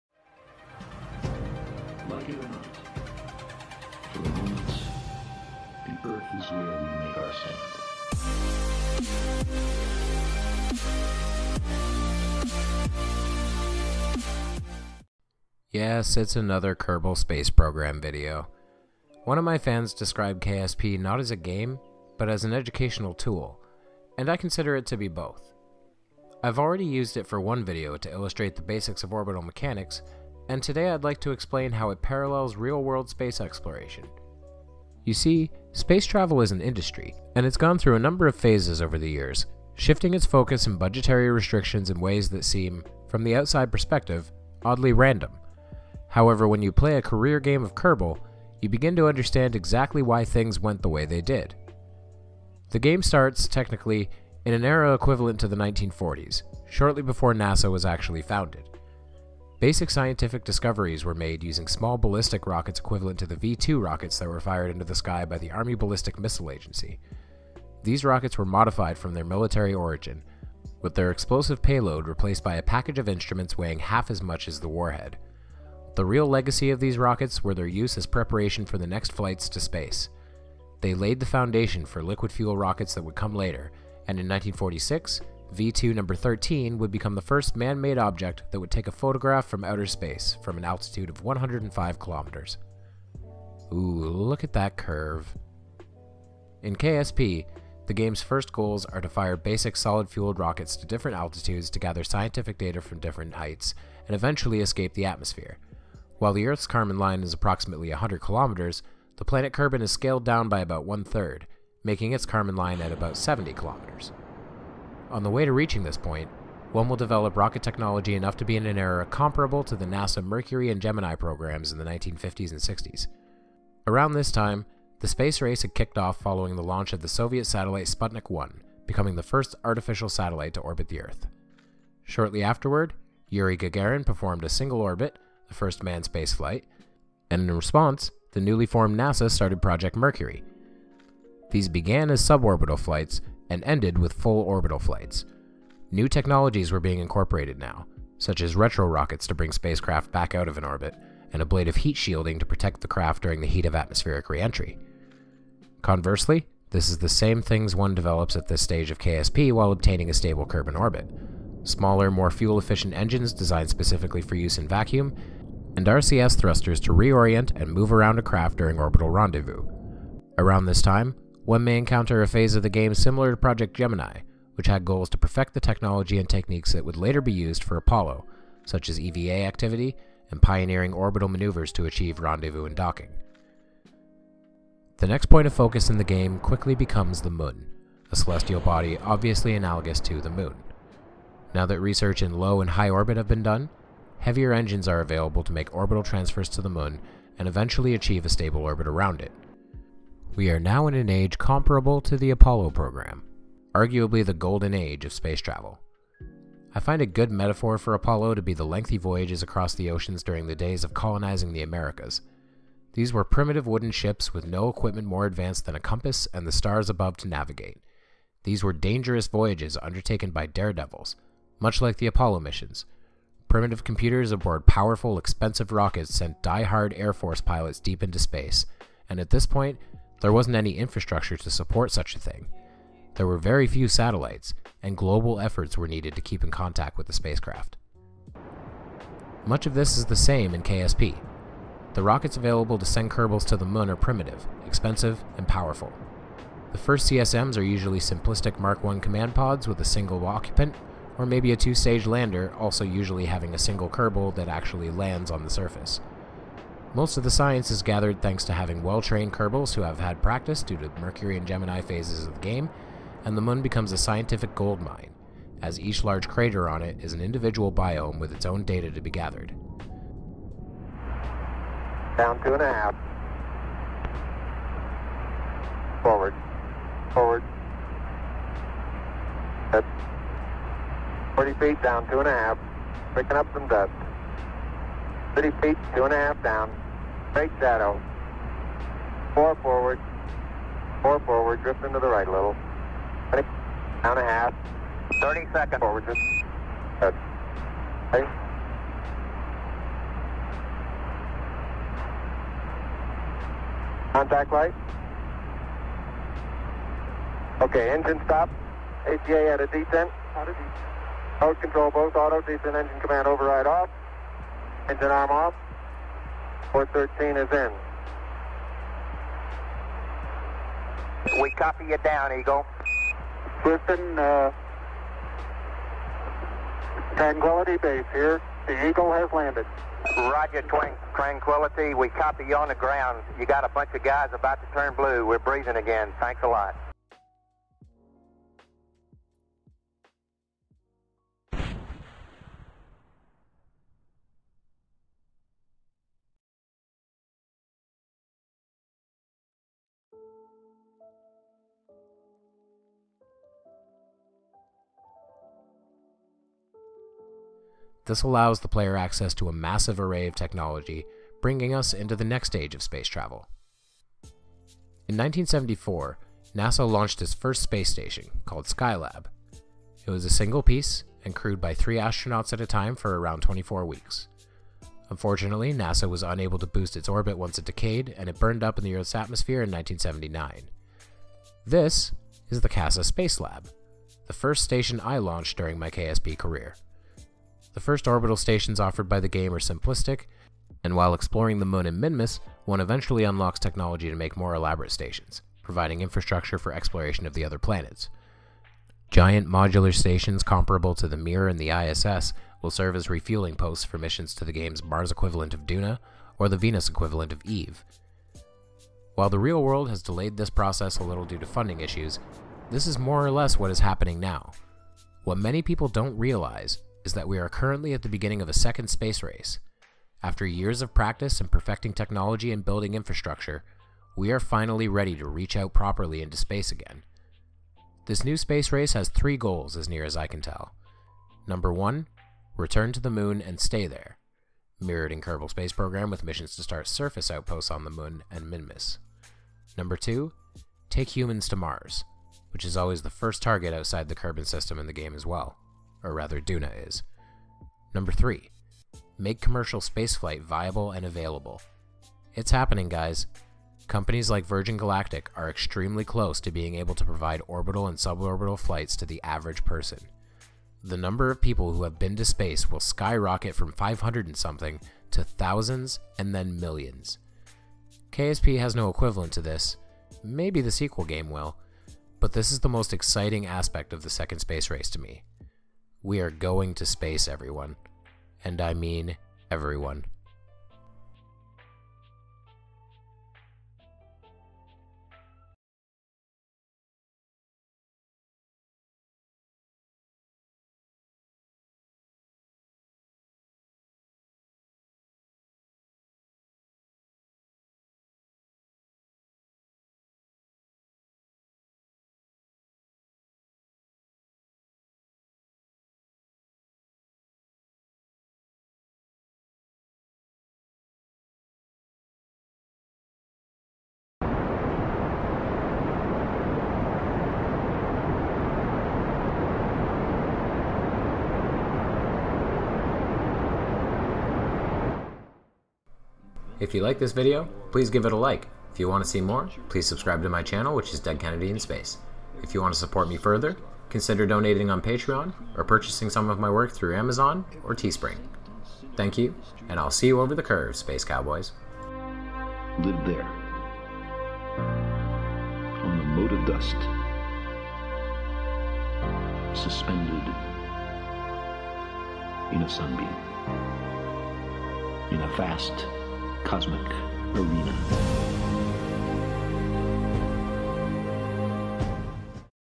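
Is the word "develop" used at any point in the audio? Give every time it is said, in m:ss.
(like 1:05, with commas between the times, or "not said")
1:56, 2:37.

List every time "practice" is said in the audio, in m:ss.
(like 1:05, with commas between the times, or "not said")
4:20, 7:00.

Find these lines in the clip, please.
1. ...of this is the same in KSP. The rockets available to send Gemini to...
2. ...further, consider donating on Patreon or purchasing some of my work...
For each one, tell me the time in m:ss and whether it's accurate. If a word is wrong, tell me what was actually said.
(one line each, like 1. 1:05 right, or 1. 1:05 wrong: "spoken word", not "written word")
1. 3:59 wrong: "Kerbals", not "Gemini"
2. 8:53 right.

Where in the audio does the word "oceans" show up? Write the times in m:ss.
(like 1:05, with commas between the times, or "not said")
3:29.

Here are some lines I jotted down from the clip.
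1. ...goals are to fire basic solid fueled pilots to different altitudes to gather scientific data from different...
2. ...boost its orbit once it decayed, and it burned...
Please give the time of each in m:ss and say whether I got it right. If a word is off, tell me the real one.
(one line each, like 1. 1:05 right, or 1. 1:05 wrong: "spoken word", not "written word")
1. 1:38 wrong: "rockets", not "pilots"
2. 6:16 right.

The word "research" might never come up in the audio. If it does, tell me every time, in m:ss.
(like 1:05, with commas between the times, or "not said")
3:11.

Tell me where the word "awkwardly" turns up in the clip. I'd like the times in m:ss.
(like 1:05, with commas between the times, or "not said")
not said.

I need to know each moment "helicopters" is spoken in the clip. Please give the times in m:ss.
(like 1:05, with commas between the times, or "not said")
not said.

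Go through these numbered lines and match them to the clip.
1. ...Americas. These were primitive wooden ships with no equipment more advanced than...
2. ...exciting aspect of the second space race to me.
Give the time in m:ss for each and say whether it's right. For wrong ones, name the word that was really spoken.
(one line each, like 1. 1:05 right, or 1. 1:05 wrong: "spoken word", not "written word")
1. 3:31 right
2. 7:52 right.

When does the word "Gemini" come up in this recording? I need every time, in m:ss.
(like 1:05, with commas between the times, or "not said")
2:00, 2:53, 4:21.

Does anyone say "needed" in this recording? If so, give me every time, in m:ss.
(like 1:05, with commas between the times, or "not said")
3:55.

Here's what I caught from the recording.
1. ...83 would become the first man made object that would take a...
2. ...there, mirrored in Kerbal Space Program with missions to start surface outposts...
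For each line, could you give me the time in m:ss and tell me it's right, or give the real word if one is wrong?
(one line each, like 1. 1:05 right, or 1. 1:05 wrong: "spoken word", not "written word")
1. 1:26 wrong: "13", not "83"
2. 7:13 right.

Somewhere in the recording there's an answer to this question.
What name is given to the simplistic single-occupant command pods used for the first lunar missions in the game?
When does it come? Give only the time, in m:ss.
4:08.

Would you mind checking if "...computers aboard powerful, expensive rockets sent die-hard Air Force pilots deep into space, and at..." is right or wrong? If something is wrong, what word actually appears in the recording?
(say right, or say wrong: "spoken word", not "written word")
right.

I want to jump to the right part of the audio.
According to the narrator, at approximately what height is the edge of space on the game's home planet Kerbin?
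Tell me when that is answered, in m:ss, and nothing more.
1:53.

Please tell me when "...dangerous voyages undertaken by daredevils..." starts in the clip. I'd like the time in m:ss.
3:38.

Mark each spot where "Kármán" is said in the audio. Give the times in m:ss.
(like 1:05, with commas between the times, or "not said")
1:46, 1:52.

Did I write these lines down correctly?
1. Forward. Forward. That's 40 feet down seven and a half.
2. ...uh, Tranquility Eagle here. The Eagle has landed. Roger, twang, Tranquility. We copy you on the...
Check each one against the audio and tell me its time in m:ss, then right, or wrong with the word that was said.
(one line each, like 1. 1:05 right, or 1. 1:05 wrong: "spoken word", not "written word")
1. 4:36 wrong: "two", not "seven"
2. 5:24 wrong: "Base", not "Eagle".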